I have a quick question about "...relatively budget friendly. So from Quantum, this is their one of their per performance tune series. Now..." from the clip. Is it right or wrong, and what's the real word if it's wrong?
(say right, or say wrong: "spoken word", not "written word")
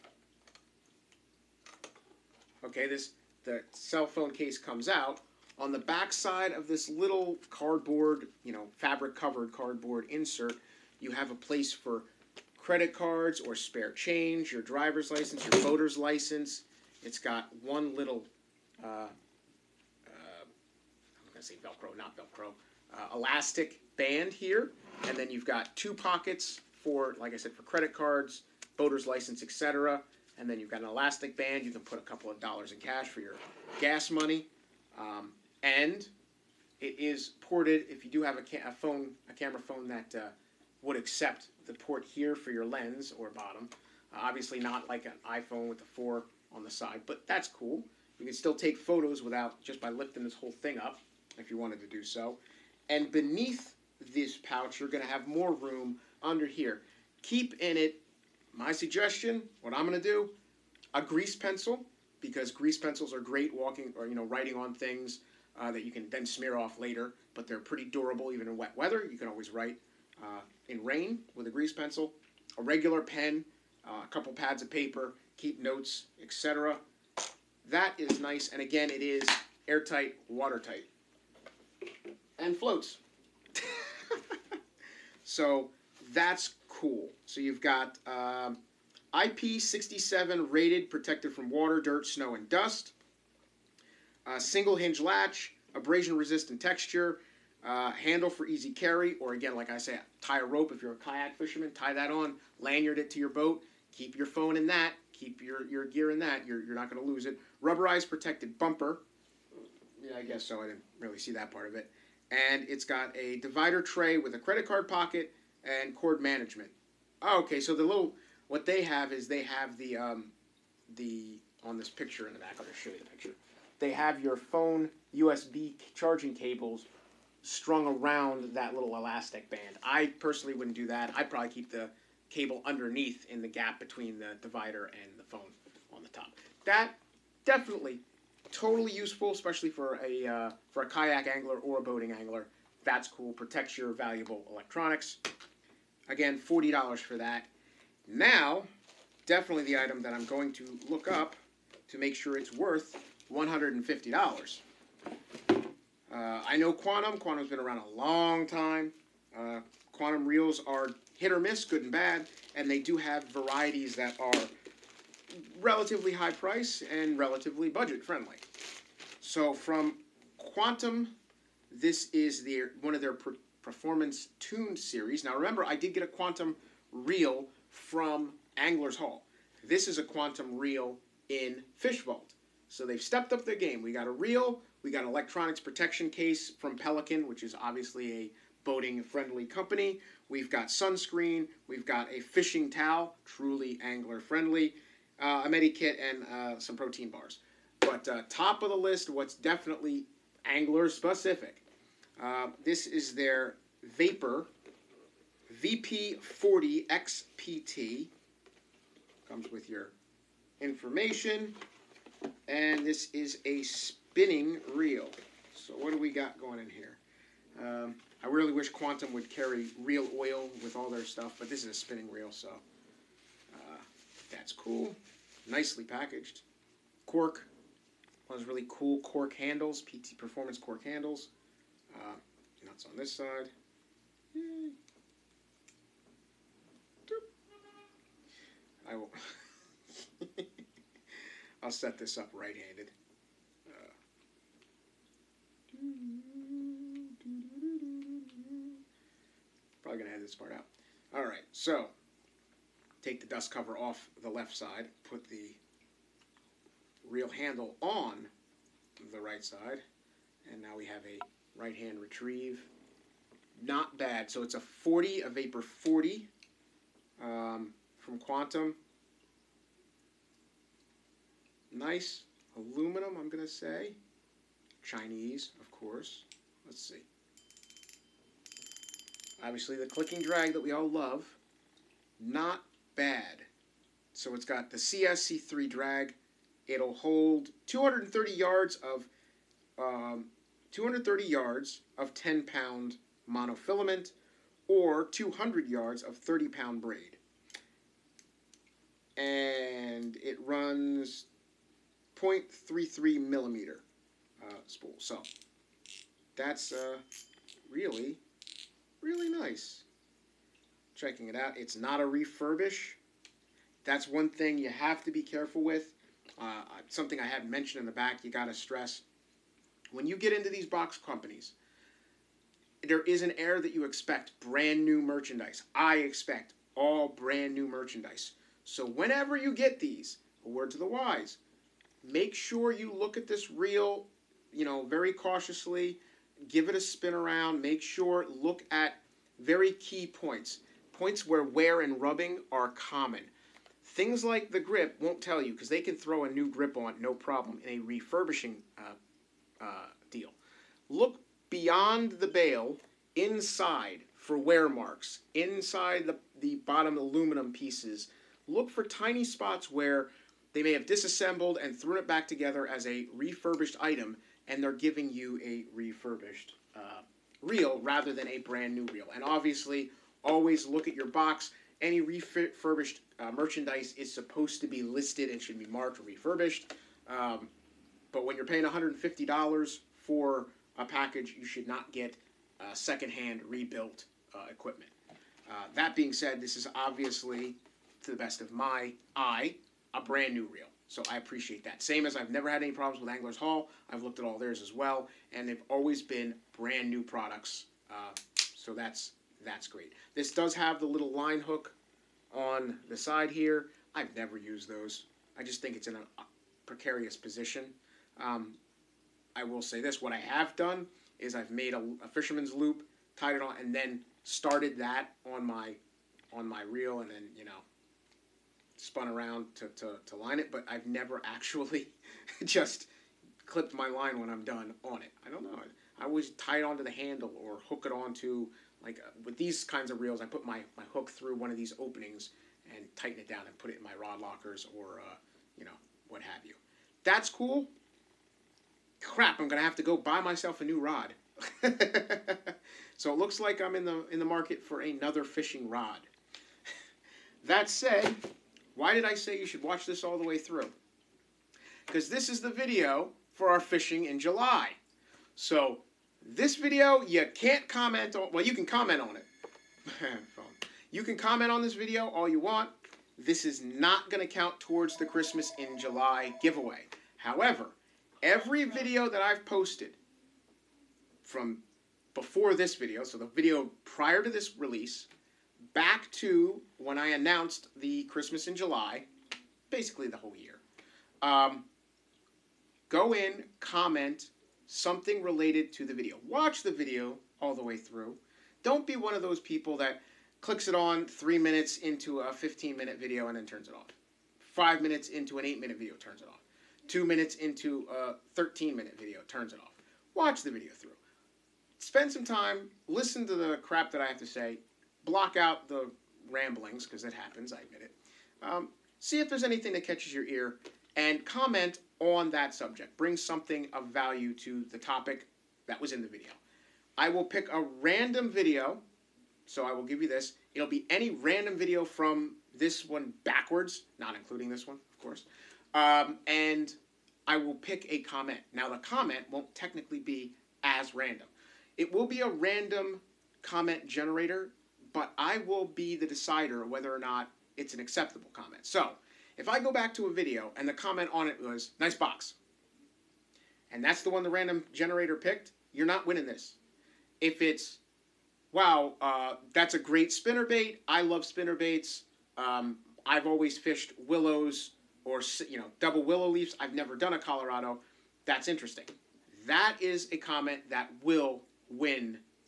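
right.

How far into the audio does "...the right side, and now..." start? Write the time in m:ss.
4:19.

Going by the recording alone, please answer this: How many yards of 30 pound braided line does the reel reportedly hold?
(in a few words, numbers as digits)
200.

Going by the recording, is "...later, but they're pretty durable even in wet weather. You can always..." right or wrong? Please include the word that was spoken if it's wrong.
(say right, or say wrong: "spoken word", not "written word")
right.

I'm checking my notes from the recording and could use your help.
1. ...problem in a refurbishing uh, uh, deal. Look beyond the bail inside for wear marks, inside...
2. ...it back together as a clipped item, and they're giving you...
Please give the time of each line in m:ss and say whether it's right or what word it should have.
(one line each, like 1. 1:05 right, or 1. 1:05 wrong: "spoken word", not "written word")
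1. 5:47 right
2. 6:01 wrong: "refurbished", not "clipped".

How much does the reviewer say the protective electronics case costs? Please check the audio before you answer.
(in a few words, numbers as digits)
$40.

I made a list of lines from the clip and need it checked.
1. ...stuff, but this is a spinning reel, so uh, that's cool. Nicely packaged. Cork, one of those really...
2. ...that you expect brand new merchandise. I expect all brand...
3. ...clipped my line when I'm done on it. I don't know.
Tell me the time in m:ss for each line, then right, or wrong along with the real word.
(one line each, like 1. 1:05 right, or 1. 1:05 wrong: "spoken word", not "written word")
1. 3:41 right
2. 5:23 right
3. 7:03 right.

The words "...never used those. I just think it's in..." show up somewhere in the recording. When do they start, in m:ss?
6:44.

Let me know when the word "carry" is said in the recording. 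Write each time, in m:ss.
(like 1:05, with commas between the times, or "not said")
1:38, 3:39.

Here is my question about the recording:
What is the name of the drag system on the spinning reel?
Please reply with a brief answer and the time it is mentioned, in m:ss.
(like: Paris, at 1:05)
CSC3, at 4:44.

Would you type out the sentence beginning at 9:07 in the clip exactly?
If it's, wow, uh, that's a great spinner bait.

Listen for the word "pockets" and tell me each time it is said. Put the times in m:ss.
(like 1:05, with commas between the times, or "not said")
0:25, 1:54.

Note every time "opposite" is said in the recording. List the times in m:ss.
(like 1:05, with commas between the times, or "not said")
not said.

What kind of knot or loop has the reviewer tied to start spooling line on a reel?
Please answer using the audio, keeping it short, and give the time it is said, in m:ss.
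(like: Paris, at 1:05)
fisherman's loop, at 6:52.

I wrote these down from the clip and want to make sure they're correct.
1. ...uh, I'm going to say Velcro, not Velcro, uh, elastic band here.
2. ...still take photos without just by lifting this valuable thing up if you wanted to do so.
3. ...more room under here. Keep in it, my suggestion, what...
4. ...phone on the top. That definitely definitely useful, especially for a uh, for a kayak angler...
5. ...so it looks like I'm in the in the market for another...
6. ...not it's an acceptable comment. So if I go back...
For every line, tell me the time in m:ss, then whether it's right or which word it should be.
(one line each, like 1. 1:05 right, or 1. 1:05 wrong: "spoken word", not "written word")
1. 0:18 right
2. 0:48 wrong: "whole", not "valuable"
3. 0:55 right
4. 2:15 wrong: "totally", not "definitely"
5. 7:22 right
6. 8:56 right.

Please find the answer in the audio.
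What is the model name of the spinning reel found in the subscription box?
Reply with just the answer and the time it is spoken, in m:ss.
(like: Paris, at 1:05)
Vapor VP40XPT, at 3:23.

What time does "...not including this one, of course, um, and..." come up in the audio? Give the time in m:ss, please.
8:43.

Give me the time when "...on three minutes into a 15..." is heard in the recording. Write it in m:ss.
8:10.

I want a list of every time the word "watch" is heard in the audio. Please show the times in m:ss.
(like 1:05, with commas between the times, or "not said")
7:29, 8:06, 8:20.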